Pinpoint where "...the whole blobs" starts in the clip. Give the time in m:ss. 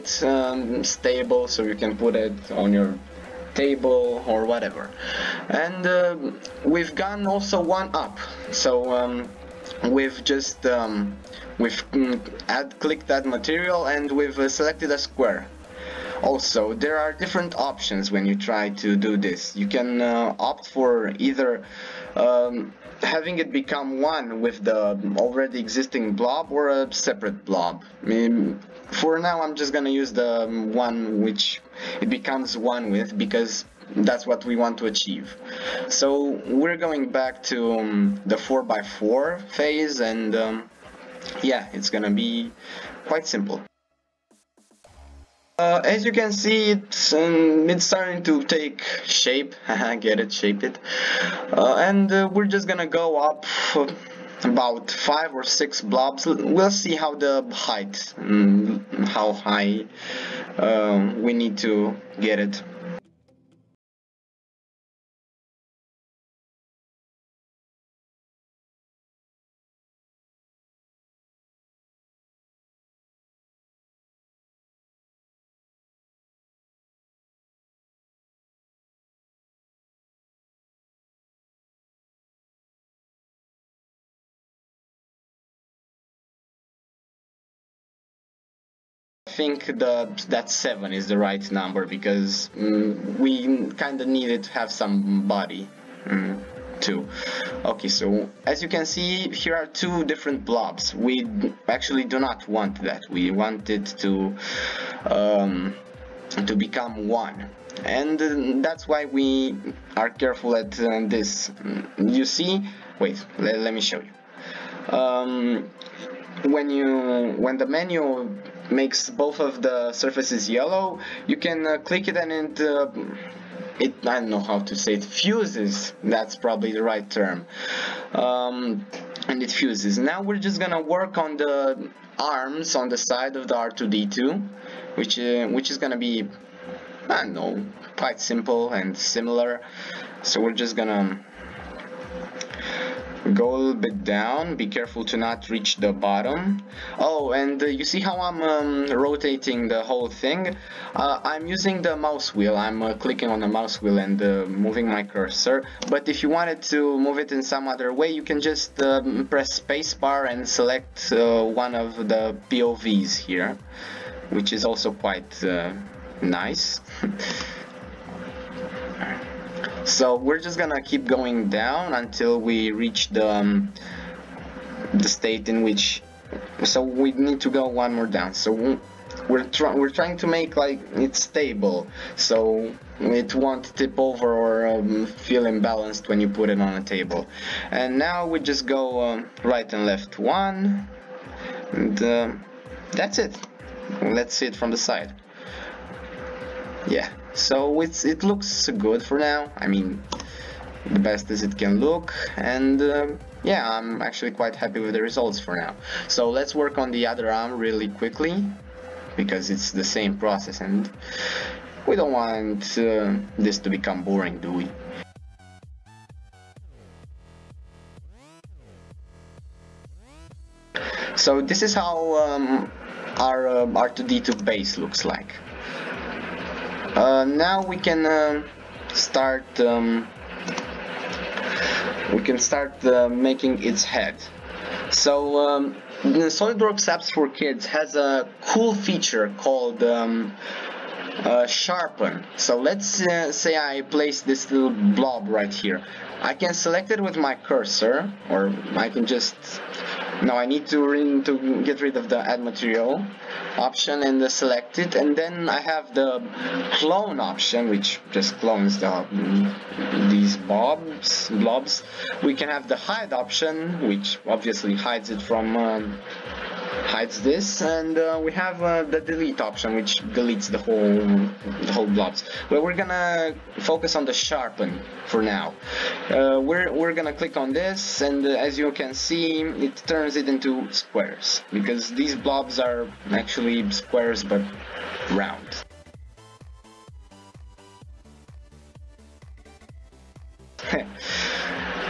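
4:31.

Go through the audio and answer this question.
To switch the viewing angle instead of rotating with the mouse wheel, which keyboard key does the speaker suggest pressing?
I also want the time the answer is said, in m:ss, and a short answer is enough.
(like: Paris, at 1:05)
Spacebar, at 2:39.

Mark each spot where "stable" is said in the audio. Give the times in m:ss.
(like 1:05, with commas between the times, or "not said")
0:00, 3:01.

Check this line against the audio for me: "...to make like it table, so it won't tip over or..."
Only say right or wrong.
wrong.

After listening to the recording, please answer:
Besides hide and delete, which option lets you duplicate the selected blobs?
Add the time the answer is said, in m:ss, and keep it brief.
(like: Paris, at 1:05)
Clone, at 4:16.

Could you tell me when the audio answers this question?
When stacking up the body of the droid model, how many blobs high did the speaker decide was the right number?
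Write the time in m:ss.
1:30.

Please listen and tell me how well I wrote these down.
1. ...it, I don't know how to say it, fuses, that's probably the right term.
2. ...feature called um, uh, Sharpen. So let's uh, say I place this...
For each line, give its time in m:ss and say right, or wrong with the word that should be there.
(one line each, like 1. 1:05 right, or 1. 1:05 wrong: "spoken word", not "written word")
1. 2:03 right
2. 3:58 right.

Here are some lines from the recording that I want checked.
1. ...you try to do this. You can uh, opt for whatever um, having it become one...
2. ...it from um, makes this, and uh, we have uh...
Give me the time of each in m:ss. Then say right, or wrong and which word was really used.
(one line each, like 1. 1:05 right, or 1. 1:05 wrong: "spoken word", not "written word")
1. 0:18 wrong: "either", not "whatever"
2. 4:25 wrong: "hides", not "makes".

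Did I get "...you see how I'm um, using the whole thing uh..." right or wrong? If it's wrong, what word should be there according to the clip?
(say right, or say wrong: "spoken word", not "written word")
wrong: "rotating", not "using".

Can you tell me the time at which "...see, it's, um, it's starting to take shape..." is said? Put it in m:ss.
0:46.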